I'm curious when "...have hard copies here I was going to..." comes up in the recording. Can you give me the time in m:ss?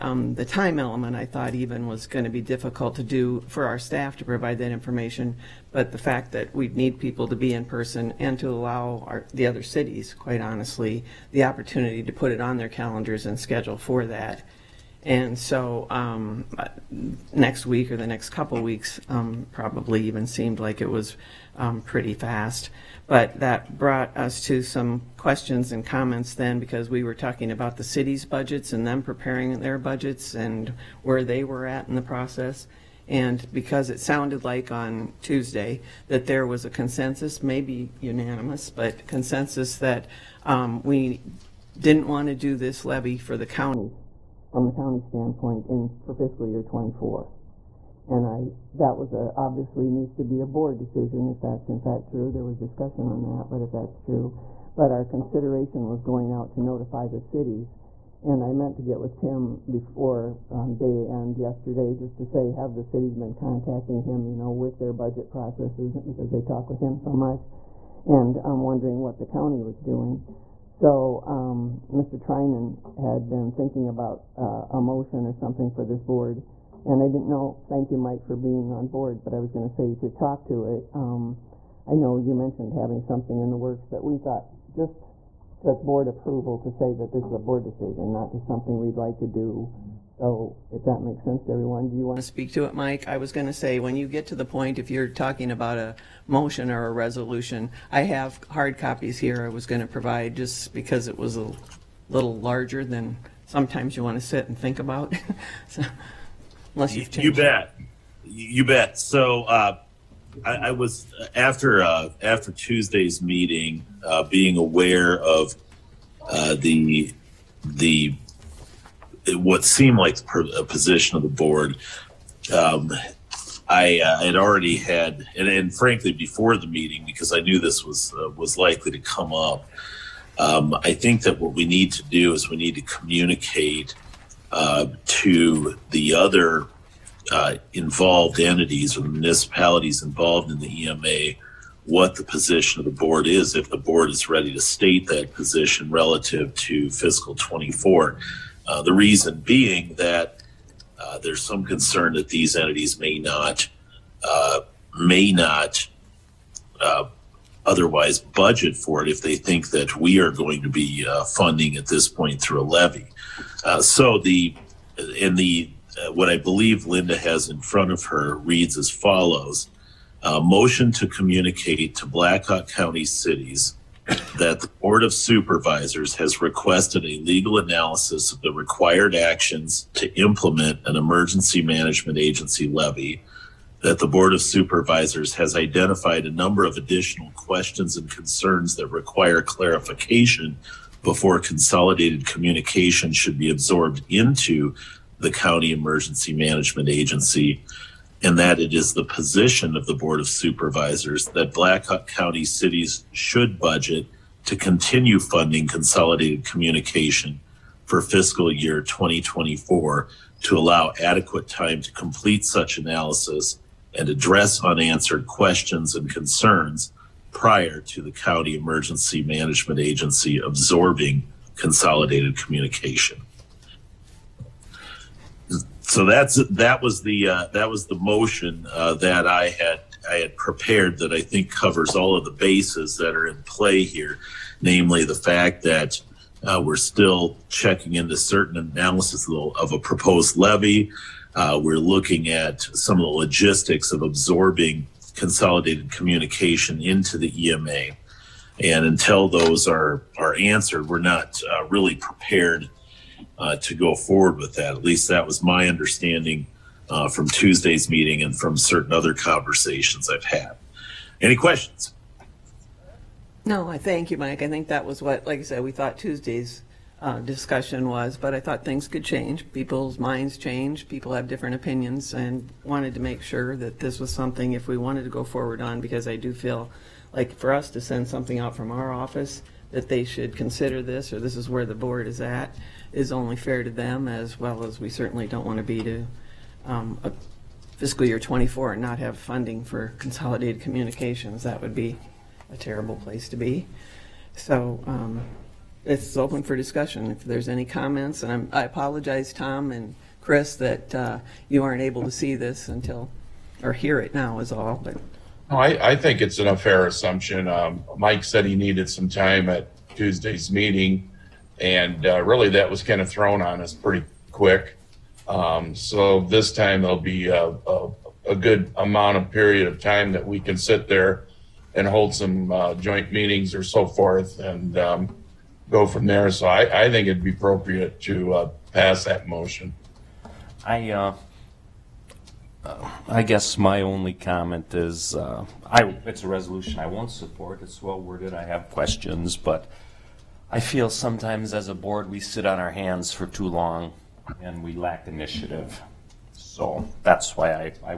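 1:38.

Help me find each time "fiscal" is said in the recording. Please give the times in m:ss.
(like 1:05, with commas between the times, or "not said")
0:46, 2:26, 3:28, 4:47.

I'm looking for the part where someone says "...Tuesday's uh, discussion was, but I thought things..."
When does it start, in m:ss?
4:25.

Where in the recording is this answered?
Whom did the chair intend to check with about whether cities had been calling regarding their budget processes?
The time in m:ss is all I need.
0:59.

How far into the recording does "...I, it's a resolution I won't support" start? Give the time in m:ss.
5:35.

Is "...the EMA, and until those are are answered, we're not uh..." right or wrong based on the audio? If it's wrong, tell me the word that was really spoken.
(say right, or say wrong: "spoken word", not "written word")
right.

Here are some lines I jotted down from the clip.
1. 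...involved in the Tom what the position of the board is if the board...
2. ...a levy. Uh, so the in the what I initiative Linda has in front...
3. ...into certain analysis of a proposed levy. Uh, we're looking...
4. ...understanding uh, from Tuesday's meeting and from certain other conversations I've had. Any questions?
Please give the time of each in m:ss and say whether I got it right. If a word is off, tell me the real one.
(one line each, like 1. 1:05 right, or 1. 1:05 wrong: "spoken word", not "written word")
1. 2:20 wrong: "EMA", not "Tom"
2. 2:42 wrong: "believe", not "initiative"
3. 3:57 right
4. 4:15 right.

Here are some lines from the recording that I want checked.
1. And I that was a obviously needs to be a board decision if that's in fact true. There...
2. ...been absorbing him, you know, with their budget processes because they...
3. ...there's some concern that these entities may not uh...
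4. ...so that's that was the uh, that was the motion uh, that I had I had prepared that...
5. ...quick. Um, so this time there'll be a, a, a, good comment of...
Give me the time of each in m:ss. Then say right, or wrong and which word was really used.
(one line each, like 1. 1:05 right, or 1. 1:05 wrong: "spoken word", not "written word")
1. 0:48 right
2. 1:03 wrong: "contacting", not "absorbing"
3. 2:31 right
4. 3:45 right
5. 5:14 wrong: "amount", not "comment".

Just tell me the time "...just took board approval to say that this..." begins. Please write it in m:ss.
1:24.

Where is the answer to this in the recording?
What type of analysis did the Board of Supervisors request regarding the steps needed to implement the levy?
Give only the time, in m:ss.
2:57.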